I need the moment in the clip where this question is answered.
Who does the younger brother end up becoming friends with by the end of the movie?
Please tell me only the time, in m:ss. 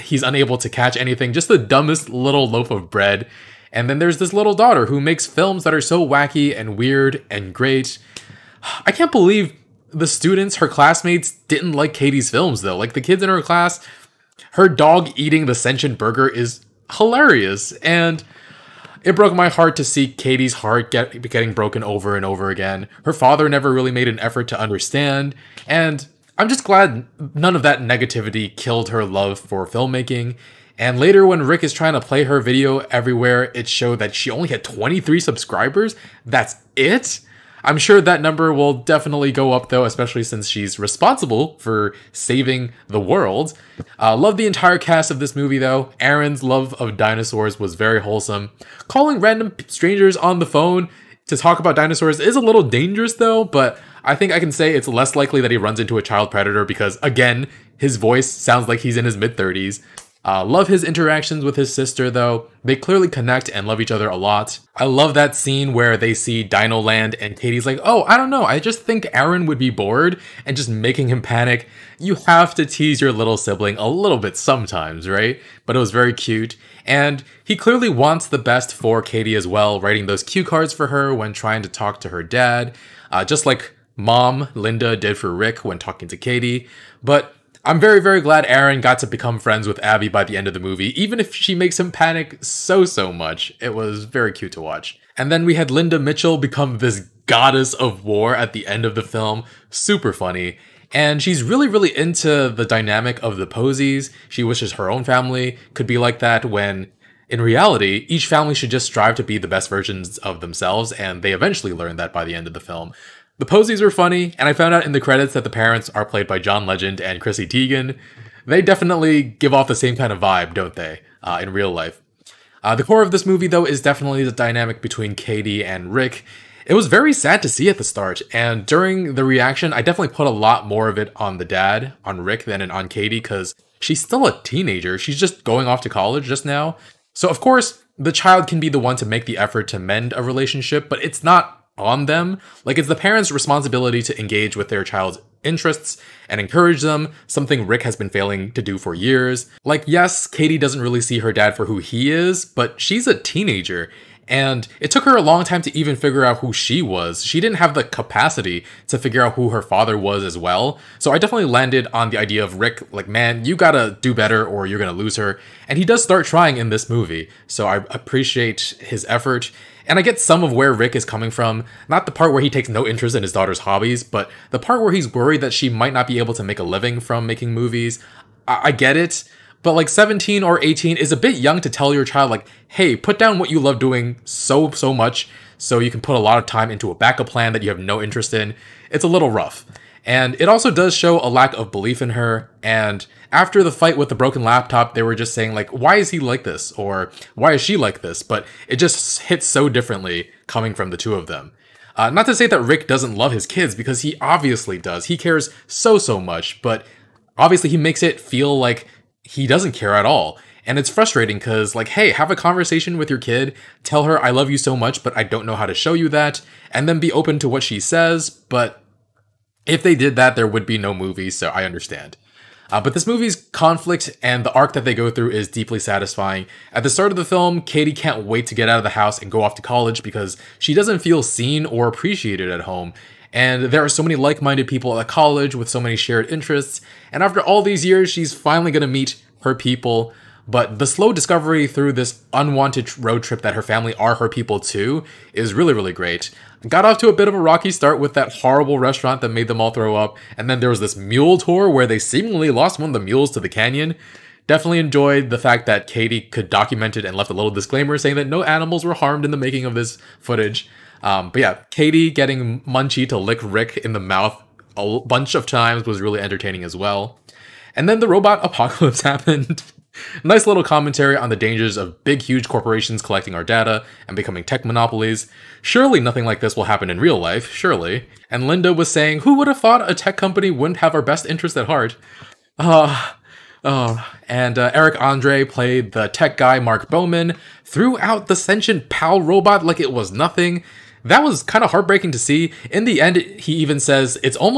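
1:29.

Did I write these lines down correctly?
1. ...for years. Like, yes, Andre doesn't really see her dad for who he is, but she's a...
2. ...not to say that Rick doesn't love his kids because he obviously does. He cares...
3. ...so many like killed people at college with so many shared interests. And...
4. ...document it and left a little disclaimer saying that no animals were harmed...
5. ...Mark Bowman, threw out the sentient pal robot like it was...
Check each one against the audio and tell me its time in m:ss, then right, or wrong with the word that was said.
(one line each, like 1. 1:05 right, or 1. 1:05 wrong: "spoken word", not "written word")
1. 2:28 wrong: "Katie", not "Andre"
2. 3:22 right
3. 3:53 wrong: "minded", not "killed"
4. 4:16 right
5. 4:46 right.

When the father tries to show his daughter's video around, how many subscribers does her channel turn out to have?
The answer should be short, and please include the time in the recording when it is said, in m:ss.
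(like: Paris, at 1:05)
23, at 0:34.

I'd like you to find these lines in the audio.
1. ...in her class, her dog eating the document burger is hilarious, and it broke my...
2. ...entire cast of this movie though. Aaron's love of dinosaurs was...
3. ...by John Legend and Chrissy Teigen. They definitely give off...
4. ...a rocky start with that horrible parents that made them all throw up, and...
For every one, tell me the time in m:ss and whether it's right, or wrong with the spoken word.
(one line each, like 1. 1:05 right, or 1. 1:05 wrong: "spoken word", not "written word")
1. 0:13 wrong: "sentient", not "document"
2. 0:44 right
3. 1:56 right
4. 4:07 wrong: "restaurant", not "parents".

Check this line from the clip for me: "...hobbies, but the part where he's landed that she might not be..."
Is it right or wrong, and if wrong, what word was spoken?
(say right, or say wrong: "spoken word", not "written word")
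wrong: "worried", not "landed".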